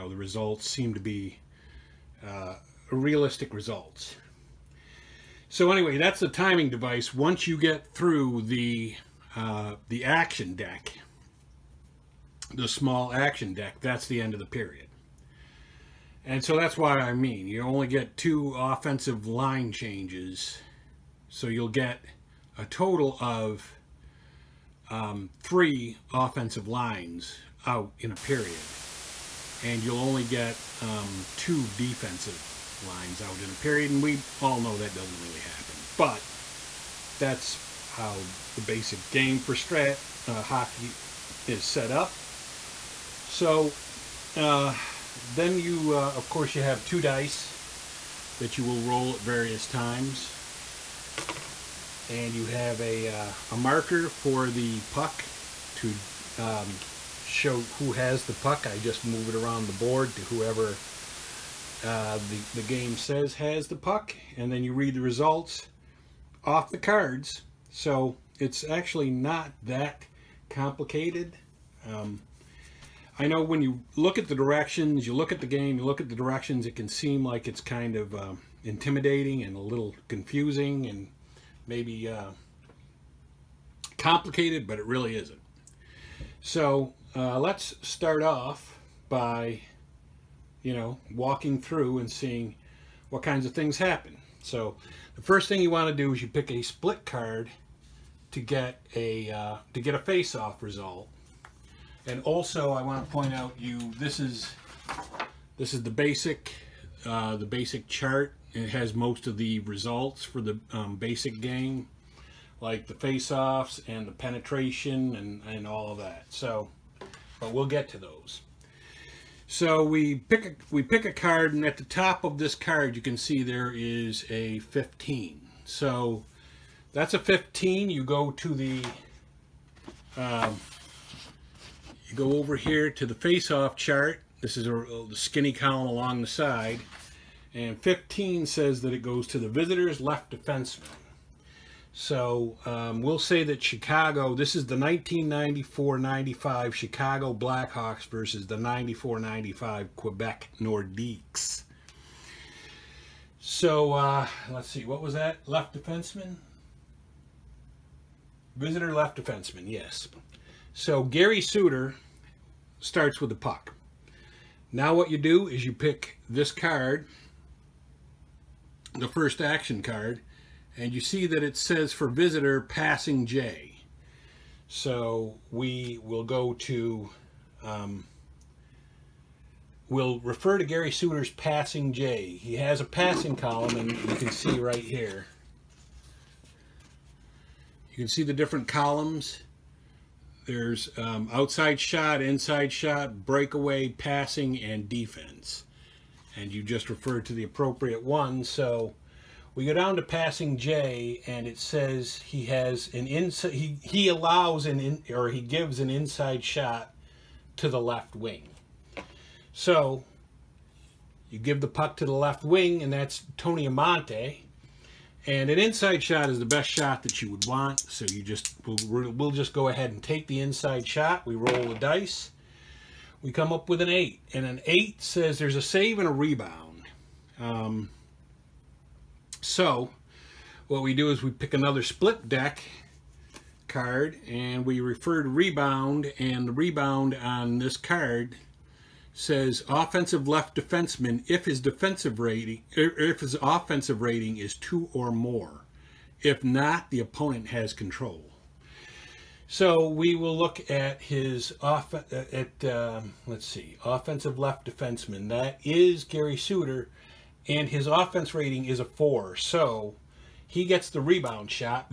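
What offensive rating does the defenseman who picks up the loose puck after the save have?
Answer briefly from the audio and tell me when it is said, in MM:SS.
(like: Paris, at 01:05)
4, at 04:18.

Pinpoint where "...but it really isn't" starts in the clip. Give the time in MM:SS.
01:24.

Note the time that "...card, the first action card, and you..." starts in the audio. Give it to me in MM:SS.
02:46.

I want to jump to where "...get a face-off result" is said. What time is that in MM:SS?
01:39.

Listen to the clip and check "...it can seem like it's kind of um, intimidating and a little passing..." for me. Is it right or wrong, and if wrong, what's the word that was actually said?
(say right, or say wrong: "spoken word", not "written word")
wrong: "confusing", not "passing".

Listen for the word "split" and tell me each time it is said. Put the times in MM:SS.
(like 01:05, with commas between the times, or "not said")
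01:36, 03:51.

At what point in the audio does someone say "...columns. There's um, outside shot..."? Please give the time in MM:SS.
03:08.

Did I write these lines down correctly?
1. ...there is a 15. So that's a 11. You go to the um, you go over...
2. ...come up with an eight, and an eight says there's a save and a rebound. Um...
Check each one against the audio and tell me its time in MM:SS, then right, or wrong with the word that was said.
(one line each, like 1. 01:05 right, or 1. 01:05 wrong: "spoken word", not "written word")
1. 02:03 wrong: "15", not "11"
2. 03:43 right.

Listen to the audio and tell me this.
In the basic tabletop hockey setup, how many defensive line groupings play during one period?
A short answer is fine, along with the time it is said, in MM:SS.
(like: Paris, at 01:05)
2, at 00:31.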